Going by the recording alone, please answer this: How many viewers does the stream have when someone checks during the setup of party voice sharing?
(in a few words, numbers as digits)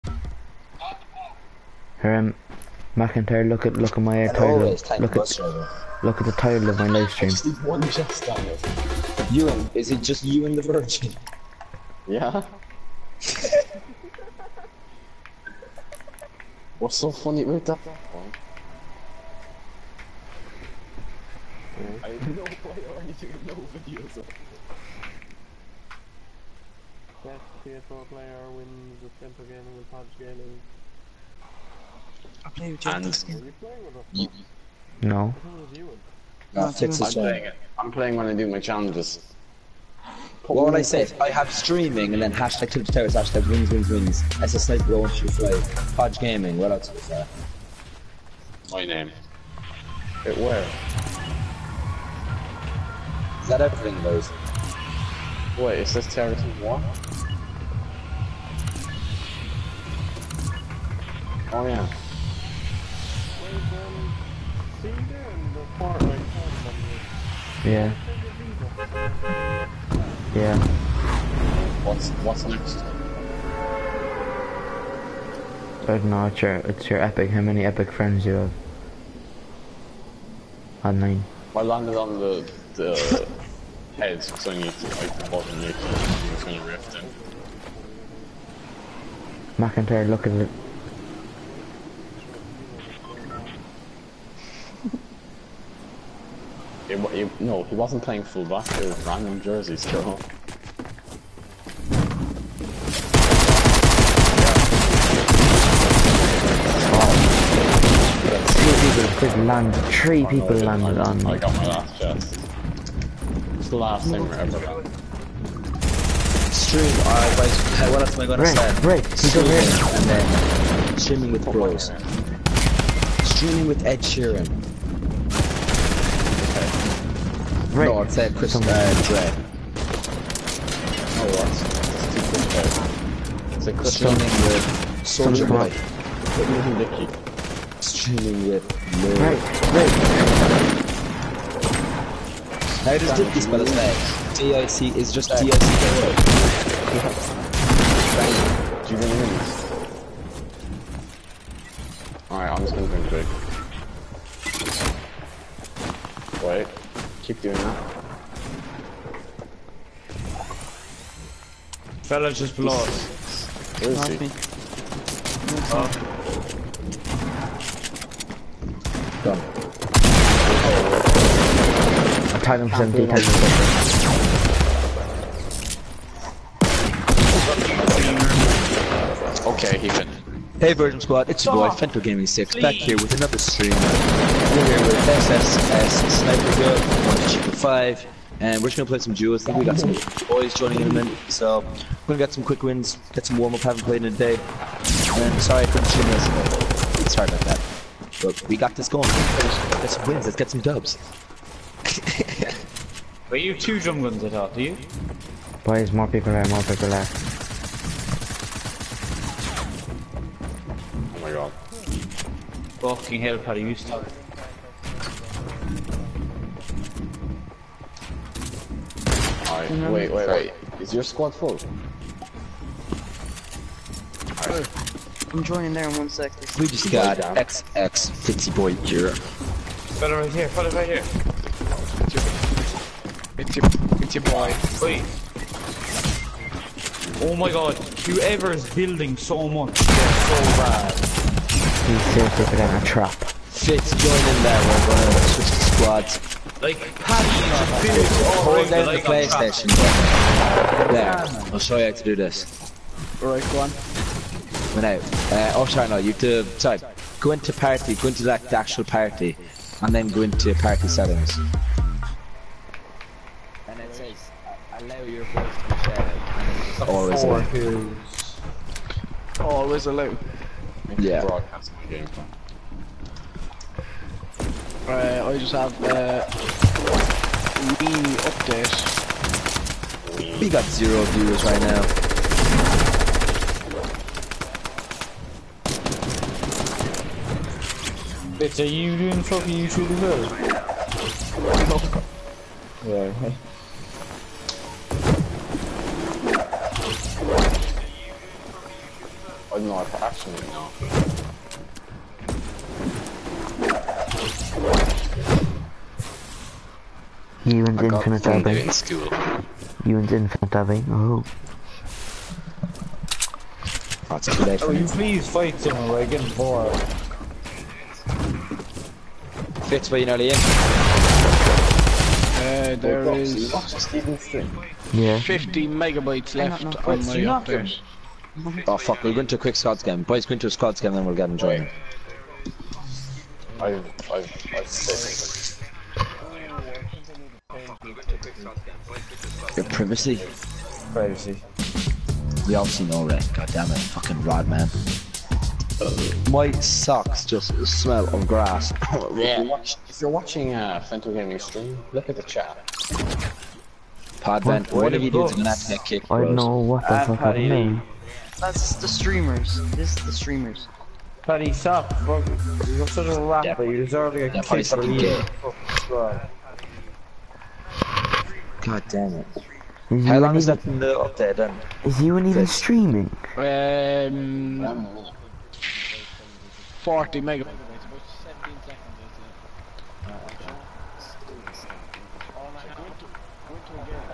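0.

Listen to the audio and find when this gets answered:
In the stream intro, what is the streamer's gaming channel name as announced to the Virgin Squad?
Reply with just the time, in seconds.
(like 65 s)
181 s.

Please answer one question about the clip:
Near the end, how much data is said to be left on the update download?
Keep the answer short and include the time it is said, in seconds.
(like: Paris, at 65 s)
40 megabytes, at 376 s.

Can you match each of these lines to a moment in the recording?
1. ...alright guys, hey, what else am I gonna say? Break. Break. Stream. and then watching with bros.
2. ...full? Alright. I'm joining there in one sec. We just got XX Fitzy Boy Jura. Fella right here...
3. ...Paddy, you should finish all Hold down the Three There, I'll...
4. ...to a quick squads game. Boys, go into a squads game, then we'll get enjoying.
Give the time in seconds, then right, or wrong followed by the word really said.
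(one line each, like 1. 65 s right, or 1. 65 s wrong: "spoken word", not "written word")
1. 117 s wrong: "streaming", not "watching"
2. 221 s right
3. 246 s wrong: "PlayStation", not "Three"
4. 329 s right.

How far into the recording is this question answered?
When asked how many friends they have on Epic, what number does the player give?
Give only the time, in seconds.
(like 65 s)
80 s.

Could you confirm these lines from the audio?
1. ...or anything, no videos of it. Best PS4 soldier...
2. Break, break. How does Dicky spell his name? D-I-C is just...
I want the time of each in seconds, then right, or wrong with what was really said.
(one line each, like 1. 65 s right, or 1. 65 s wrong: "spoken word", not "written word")
1. 22 s wrong: "player", not "soldier"
2. 139 s right.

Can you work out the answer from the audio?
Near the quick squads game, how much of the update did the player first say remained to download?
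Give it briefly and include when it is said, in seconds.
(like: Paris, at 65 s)
50 megabytes, at 325 s.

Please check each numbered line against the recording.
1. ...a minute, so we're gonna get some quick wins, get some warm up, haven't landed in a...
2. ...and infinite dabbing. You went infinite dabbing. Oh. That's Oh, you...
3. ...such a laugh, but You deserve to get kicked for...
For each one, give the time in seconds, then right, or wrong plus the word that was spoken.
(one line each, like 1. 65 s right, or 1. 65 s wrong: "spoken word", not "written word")
1. 190 s wrong: "played", not "landed"
2. 307 s right
3. 362 s right.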